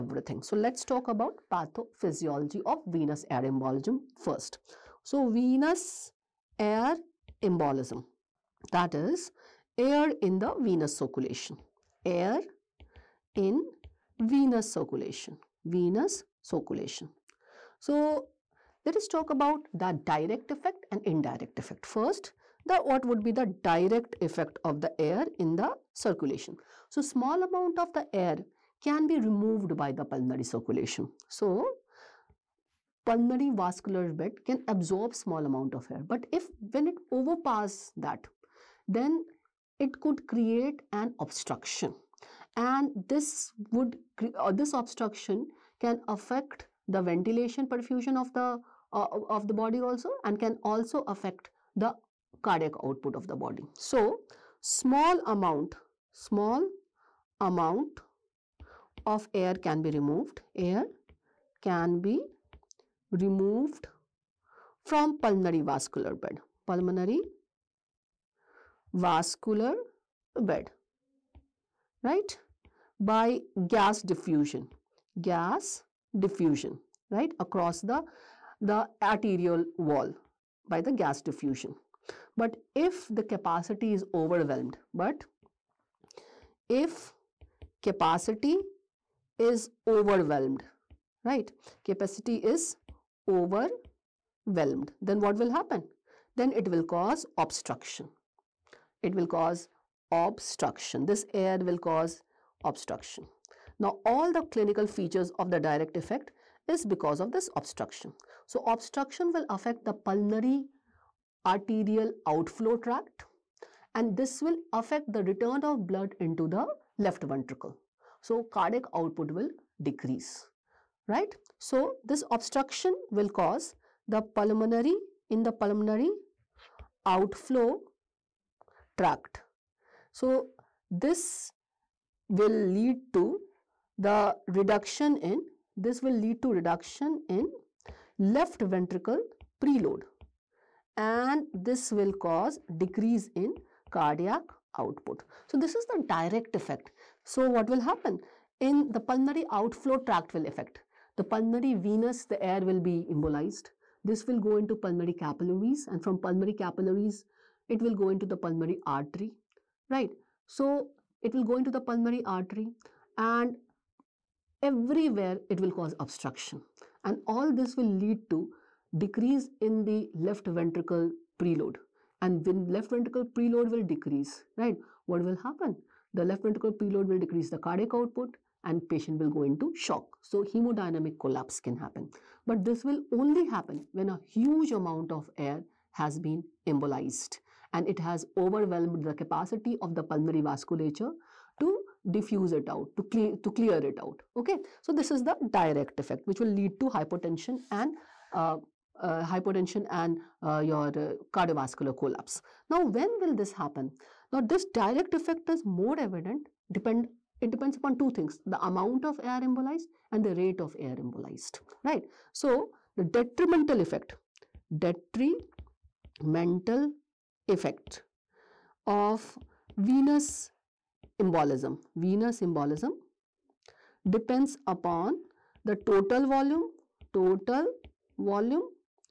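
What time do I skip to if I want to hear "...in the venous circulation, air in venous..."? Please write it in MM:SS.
00:10.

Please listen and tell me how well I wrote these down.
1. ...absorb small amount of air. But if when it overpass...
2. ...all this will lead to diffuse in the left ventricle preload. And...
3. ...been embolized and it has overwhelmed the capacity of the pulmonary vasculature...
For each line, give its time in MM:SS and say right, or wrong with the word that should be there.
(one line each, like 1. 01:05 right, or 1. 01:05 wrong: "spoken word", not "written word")
1. 00:34 right
2. 02:47 wrong: "decrease", not "diffuse"
3. 03:06 right.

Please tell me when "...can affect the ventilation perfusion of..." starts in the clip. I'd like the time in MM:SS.
00:45.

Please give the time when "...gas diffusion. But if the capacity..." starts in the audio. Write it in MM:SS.
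01:20.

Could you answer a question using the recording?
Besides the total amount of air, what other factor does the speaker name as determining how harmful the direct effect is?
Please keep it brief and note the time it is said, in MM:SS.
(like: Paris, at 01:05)
Rate of air embolized, at 03:30.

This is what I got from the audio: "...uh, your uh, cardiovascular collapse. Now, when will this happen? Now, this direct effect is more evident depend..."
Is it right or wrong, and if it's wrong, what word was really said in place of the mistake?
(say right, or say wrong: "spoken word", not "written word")
right.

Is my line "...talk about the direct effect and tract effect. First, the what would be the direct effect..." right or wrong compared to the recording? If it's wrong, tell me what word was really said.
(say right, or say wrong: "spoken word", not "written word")
wrong: "indirect", not "tract".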